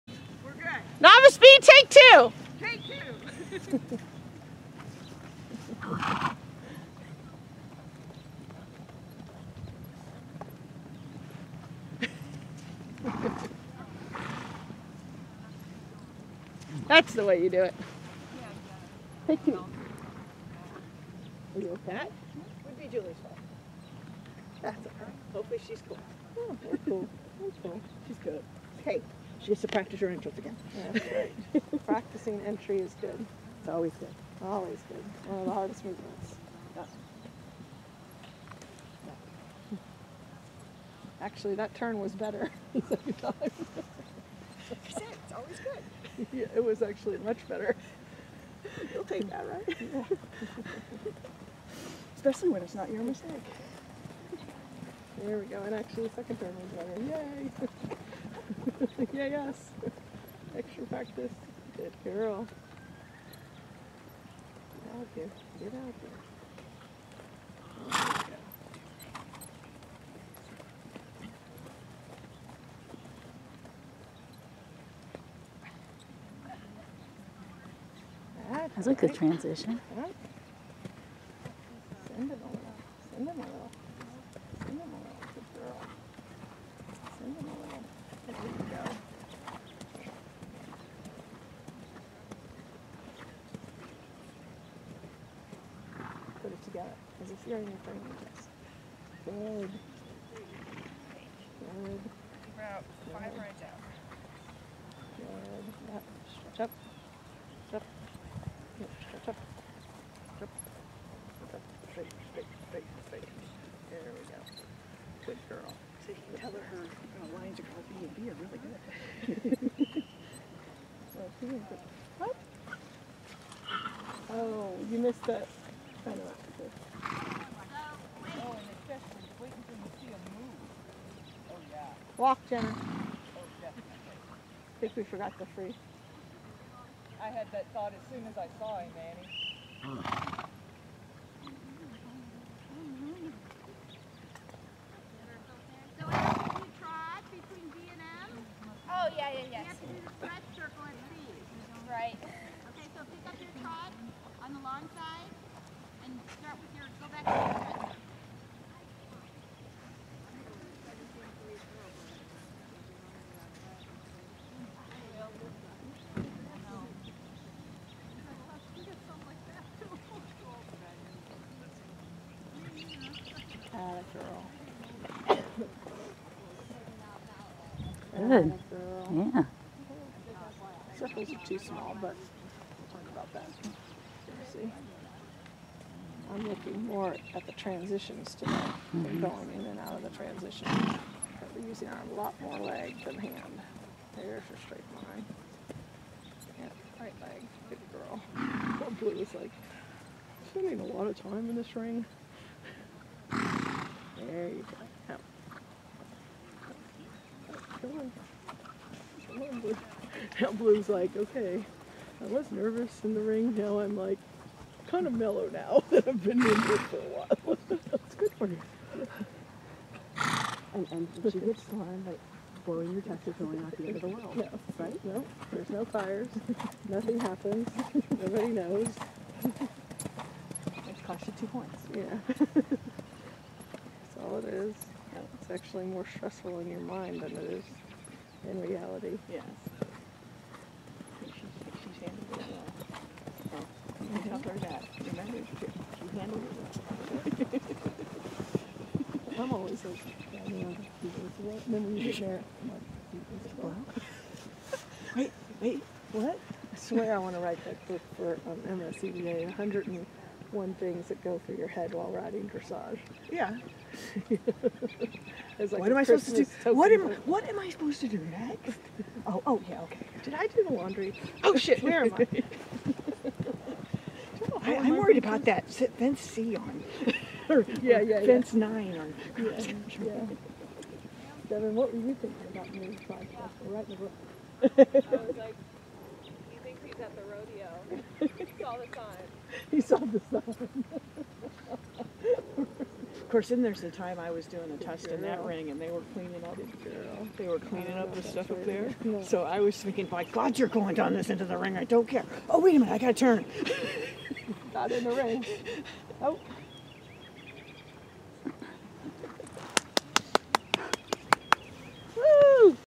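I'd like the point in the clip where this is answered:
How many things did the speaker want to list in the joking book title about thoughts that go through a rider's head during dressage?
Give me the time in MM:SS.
04:19.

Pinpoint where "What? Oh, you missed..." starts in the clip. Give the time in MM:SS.
02:02.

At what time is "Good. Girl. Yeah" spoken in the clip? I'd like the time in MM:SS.
02:58.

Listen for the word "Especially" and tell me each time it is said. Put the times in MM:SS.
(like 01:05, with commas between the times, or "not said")
00:52.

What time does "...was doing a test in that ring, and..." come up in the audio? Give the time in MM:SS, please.
04:54.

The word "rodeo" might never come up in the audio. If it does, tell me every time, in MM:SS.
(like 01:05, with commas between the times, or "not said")
04:47.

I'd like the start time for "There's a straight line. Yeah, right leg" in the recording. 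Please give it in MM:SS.
03:14.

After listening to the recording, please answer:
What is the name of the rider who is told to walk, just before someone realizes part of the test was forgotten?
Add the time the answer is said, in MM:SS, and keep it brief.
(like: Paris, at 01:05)
Jenna, at 02:12.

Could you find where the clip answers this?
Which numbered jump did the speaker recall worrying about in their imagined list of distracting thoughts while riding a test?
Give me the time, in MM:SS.
04:38.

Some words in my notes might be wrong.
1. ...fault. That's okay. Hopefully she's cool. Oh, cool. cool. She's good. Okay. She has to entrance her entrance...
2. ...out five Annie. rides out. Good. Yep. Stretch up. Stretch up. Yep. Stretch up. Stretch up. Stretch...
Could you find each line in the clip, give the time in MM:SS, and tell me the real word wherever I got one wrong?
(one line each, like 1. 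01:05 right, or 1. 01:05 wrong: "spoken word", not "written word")
1. 00:23 wrong: "practice", not "entrance"
2. 01:42 wrong: "Good", not "Annie".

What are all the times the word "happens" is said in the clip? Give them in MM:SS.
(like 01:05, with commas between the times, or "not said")
03:47.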